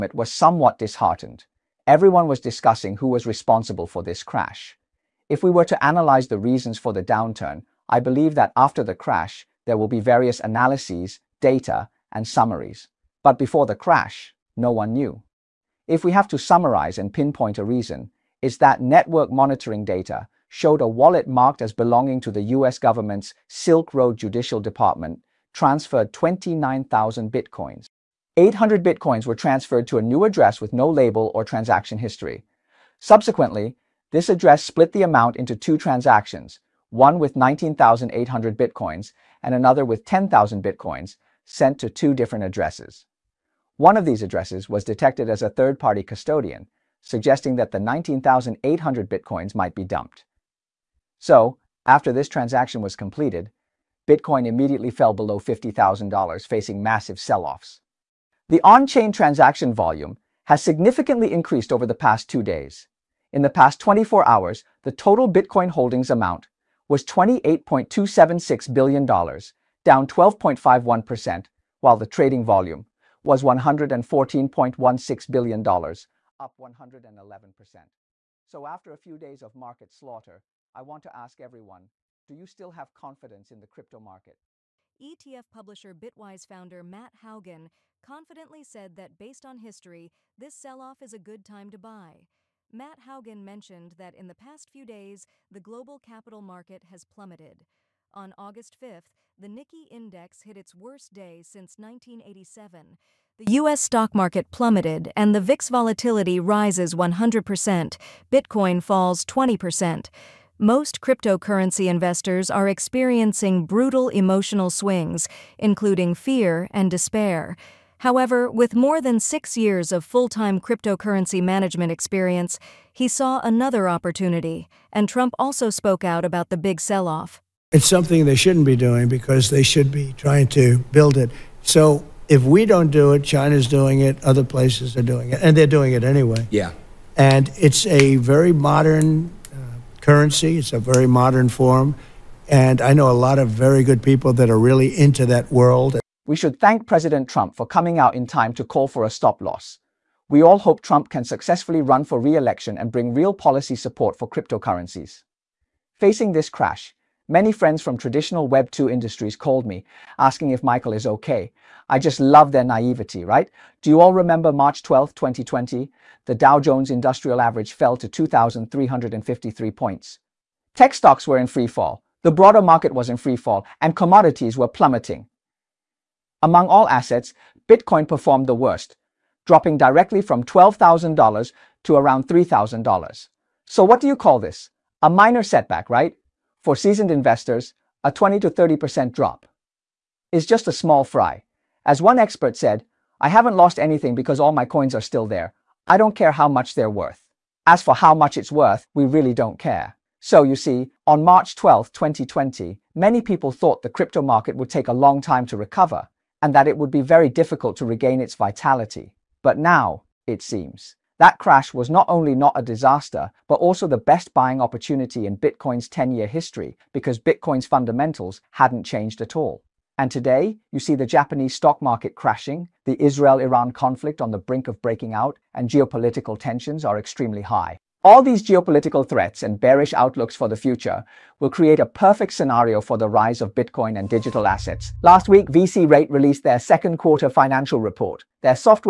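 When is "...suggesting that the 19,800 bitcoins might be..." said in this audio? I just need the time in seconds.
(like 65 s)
46 s.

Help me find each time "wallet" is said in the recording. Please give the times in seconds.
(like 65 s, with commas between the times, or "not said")
20 s.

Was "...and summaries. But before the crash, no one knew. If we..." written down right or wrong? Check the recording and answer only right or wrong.
right.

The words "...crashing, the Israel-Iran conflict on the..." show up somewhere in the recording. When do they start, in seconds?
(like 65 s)
222 s.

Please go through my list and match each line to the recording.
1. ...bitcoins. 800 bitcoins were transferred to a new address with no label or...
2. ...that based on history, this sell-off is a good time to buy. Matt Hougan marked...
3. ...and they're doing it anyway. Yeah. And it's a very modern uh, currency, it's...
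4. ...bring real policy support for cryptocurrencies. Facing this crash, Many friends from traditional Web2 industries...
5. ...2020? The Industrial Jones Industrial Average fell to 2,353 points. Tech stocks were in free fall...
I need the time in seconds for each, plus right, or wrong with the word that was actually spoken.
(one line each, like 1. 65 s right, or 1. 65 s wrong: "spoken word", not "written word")
1. 27 s right
2. 88 s wrong: "mentioned", not "marked"
3. 135 s right
4. 152 s right
5. 165 s wrong: "Dow", not "Industrial".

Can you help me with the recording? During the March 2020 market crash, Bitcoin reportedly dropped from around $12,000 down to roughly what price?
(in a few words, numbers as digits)
$3,000.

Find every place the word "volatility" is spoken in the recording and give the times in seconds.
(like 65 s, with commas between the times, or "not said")
105 s.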